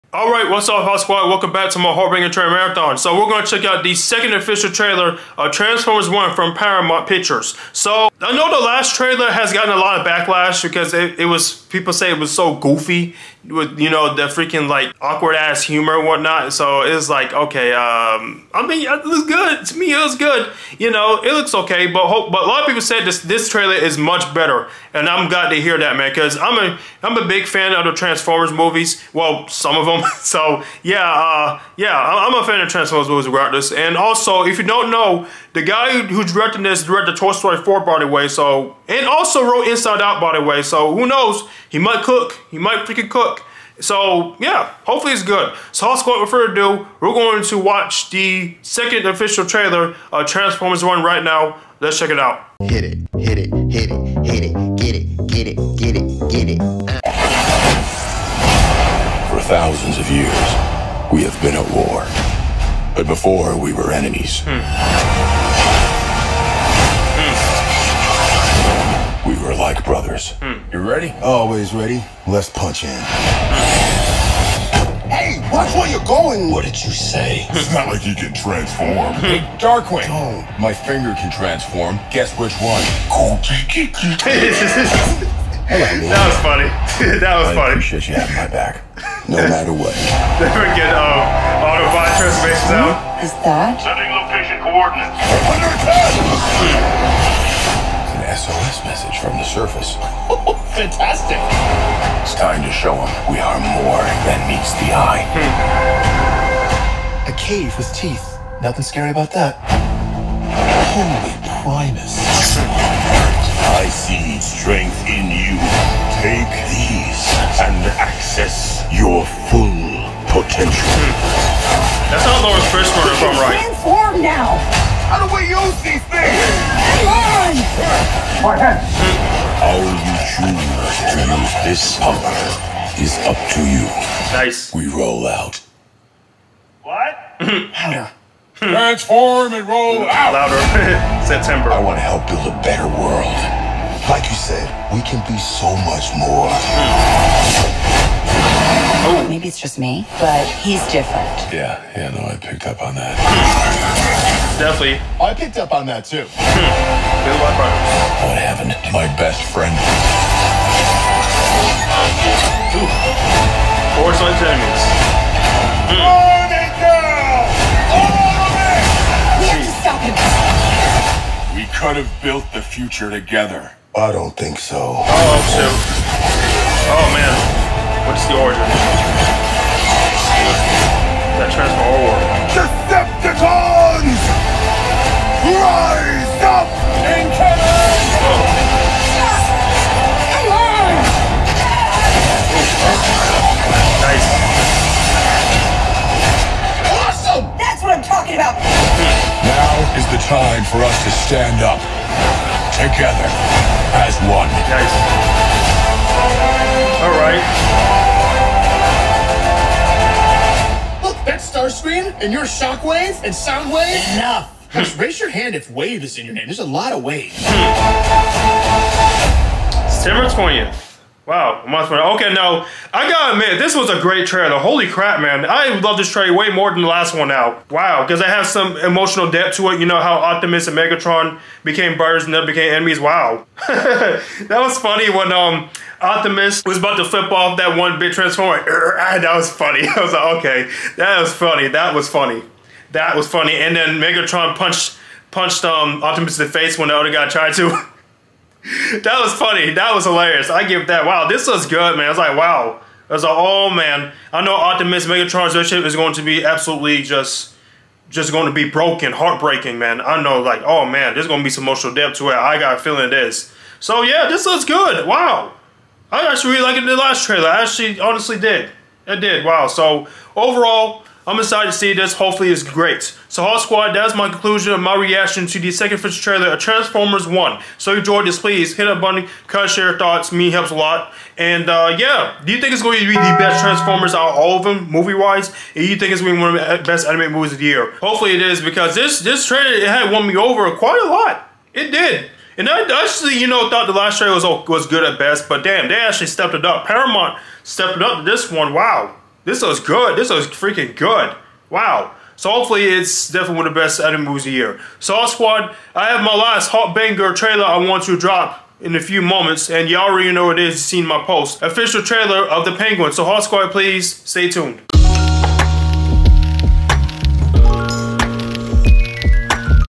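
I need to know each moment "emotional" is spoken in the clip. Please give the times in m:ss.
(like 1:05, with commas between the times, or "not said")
3:48, 4:21.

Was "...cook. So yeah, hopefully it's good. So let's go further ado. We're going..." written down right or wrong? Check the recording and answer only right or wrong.
right.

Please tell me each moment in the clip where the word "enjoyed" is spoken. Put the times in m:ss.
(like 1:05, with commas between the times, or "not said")
4:37.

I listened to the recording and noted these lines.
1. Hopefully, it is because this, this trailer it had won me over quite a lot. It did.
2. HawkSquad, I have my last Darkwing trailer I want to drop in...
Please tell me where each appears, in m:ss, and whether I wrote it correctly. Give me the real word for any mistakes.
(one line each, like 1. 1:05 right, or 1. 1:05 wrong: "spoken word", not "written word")
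1. 4:48 right
2. 5:04 wrong: "HawkBanger", not "Darkwing".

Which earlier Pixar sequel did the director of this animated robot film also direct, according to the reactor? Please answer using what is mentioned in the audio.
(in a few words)
Toy Story 4.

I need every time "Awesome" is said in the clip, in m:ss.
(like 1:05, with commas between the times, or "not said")
3:16.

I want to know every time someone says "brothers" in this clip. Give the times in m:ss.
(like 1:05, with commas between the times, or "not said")
1:09, 3:51.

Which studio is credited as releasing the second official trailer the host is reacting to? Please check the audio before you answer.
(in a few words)
Paramount Pictures.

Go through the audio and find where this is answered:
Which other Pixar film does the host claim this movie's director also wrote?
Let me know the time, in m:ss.
0:39.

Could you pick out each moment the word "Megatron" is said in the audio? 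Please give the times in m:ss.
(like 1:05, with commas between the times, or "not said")
3:50, 4:03, 4:15.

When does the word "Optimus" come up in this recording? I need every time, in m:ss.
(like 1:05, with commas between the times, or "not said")
3:50, 3:56, 4:06, 4:14.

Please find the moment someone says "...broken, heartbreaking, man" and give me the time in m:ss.
4:18.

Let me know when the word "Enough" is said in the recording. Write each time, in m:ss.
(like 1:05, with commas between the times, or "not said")
3:34.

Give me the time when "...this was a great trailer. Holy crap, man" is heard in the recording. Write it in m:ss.
3:43.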